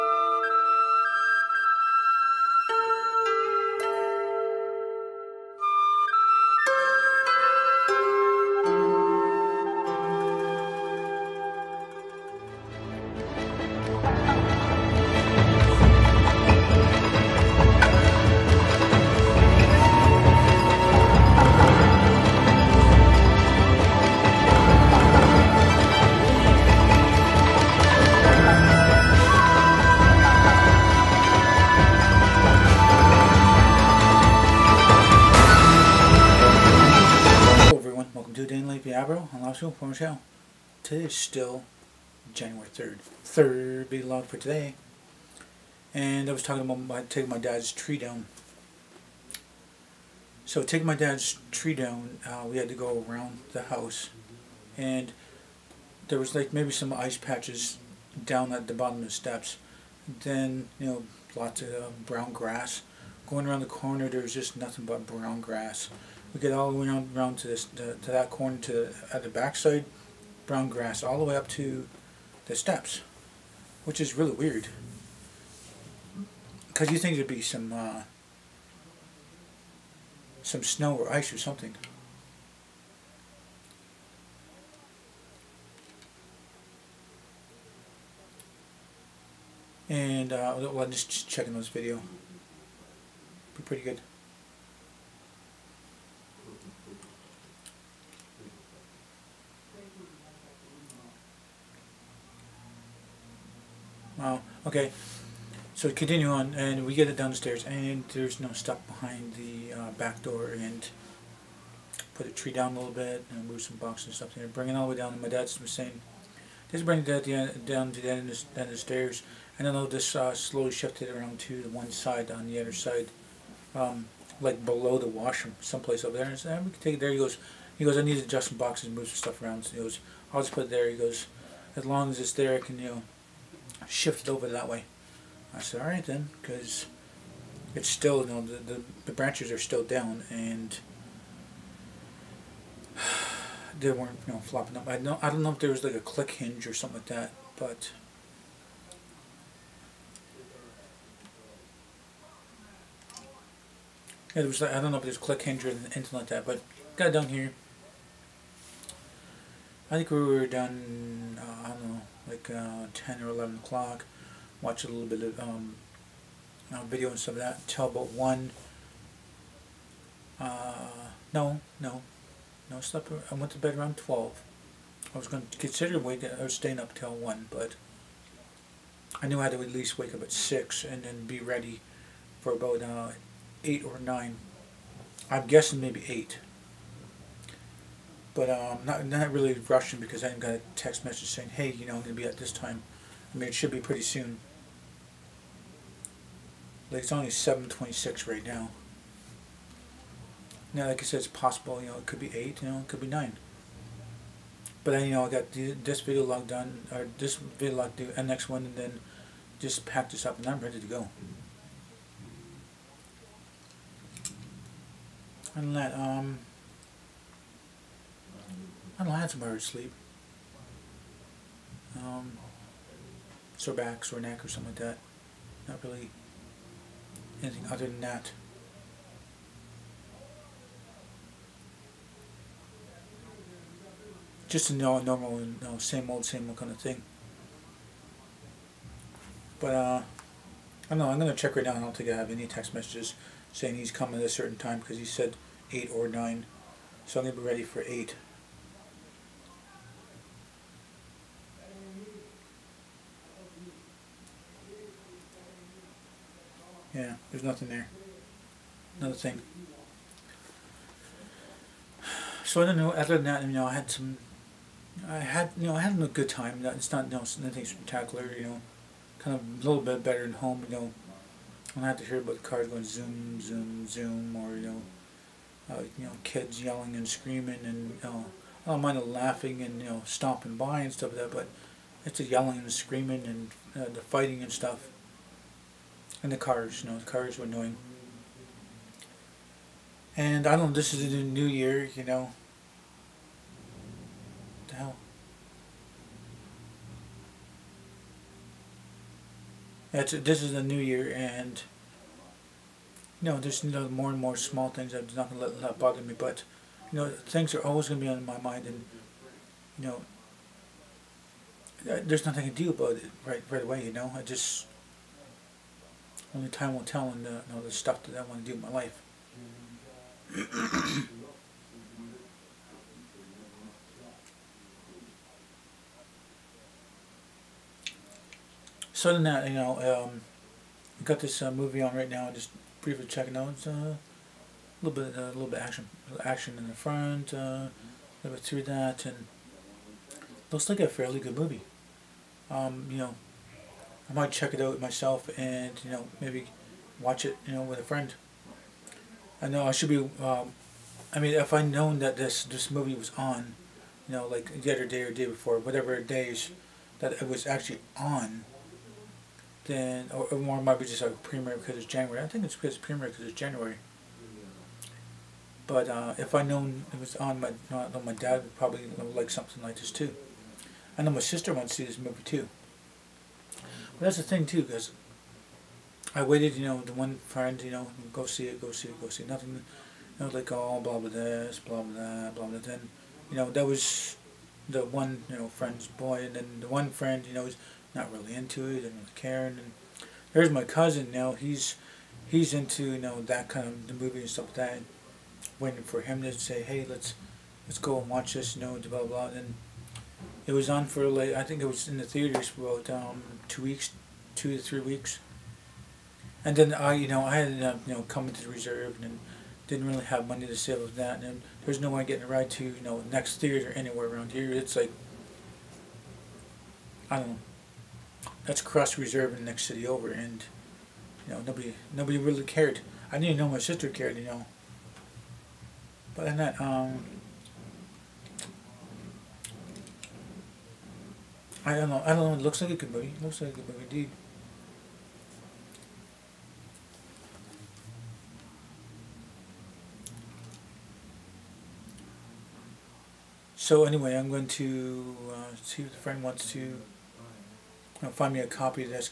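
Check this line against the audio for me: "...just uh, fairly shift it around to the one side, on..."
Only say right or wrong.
wrong.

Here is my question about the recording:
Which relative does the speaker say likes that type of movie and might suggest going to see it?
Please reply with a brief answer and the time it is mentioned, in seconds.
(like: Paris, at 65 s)
cousin, at 390 s.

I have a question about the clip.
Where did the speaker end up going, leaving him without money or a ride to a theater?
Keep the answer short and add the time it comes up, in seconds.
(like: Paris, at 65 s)
the reserve, at 408 s.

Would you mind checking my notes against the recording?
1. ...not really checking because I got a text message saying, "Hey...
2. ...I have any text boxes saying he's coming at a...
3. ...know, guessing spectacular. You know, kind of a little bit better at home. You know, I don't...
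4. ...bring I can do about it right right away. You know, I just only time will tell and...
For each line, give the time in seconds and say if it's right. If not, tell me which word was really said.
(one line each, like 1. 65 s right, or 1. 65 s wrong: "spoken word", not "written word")
1. 189 s wrong: "rushing", not "checking"
2. 242 s wrong: "messages", not "boxes"
3. 267 s wrong: "nothing", not "guessing"
4. 312 s wrong: "nothing", not "bring".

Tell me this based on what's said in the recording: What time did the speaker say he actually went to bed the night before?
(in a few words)
around 12.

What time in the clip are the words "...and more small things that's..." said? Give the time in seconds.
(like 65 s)
304 s.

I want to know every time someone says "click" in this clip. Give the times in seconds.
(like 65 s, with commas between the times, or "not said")
146 s, 155 s.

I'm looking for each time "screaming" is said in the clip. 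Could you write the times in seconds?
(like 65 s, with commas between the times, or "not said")
277 s, 282 s.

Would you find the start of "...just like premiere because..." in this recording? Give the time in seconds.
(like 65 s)
360 s.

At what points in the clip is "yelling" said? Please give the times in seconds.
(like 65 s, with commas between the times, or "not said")
276 s, 282 s.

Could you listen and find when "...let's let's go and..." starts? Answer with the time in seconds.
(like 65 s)
396 s.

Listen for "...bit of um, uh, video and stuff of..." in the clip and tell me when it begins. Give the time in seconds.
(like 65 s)
165 s.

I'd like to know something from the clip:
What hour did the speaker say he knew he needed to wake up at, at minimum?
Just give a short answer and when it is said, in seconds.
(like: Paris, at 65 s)
6, at 180 s.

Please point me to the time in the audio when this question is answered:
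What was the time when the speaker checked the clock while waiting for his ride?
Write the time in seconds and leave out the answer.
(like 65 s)
197 s.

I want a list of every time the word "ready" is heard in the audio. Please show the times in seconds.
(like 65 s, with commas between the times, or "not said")
181 s, 210 s, 247 s.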